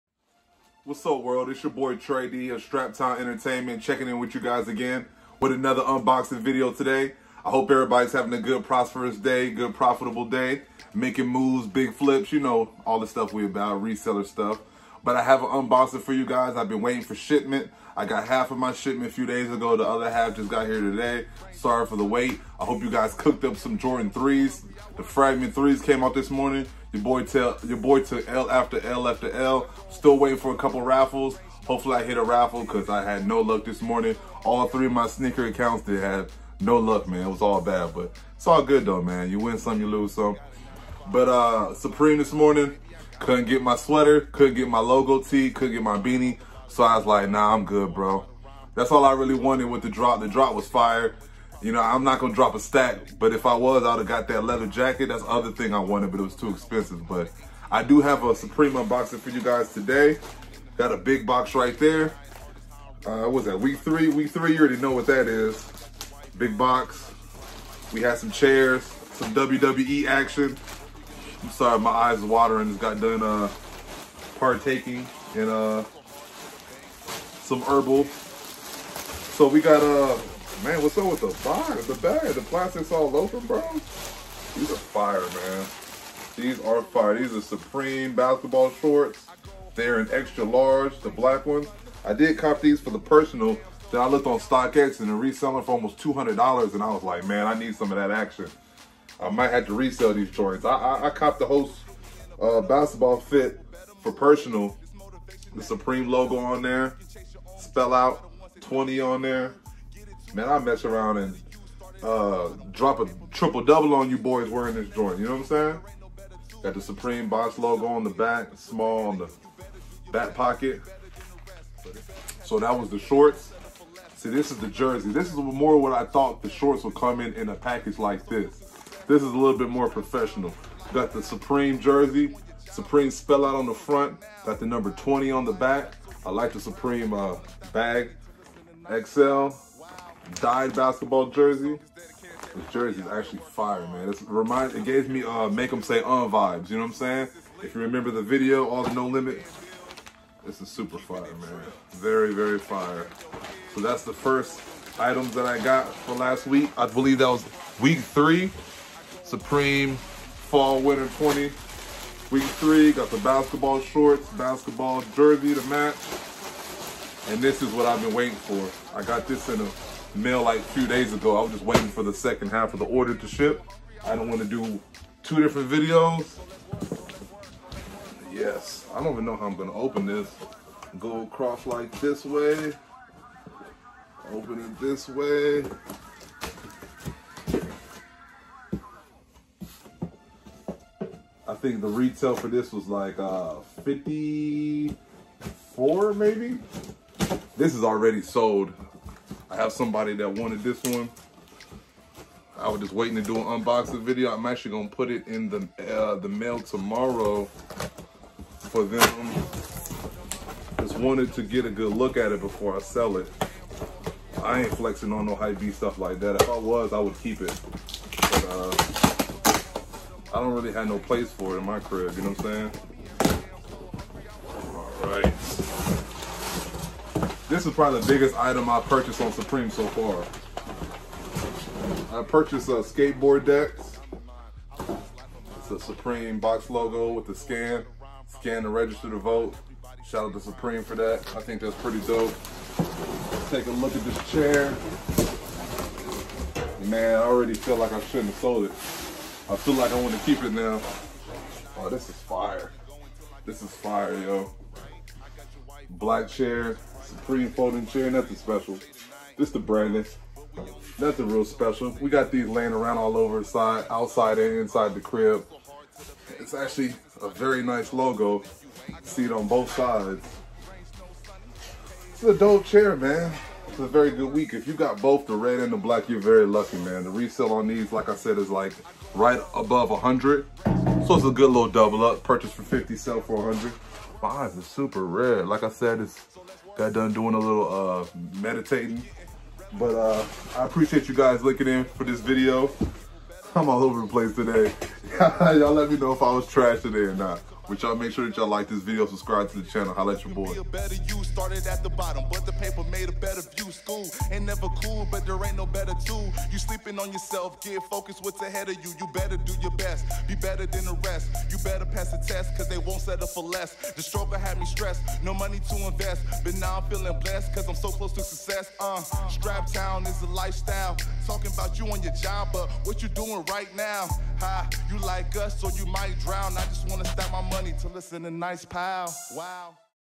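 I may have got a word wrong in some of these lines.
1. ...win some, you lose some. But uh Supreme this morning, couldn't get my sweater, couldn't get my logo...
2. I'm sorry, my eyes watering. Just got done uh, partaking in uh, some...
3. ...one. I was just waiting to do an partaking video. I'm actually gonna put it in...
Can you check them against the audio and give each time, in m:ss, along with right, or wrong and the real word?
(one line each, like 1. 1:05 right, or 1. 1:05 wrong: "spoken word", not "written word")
1. 0:39 right
2. 1:11 right
3. 3:20 wrong: "unboxing", not "partaking".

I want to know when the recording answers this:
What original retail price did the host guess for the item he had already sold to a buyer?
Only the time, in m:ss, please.
3:13.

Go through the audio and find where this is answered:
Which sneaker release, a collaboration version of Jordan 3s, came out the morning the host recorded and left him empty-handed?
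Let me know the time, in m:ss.
0:25.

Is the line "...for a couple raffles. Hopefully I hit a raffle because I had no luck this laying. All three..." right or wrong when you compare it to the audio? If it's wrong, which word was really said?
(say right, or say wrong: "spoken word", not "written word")
wrong: "morning", not "laying".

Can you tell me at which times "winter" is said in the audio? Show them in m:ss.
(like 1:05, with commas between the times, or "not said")
2:40.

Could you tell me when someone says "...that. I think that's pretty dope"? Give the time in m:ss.
4:00.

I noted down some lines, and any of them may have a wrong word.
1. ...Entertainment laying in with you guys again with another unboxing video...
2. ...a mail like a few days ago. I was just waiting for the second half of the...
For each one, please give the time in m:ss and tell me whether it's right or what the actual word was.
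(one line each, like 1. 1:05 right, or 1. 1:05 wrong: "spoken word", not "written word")
1. 0:03 wrong: "checking", not "laying"
2. 2:49 right.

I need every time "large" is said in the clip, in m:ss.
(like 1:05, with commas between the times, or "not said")
1:30.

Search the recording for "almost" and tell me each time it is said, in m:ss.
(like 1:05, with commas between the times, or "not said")
1:35.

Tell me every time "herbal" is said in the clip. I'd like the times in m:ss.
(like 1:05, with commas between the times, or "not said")
1:17.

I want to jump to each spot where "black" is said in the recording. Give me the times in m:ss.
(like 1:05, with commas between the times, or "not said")
1:31, 4:15, 4:35.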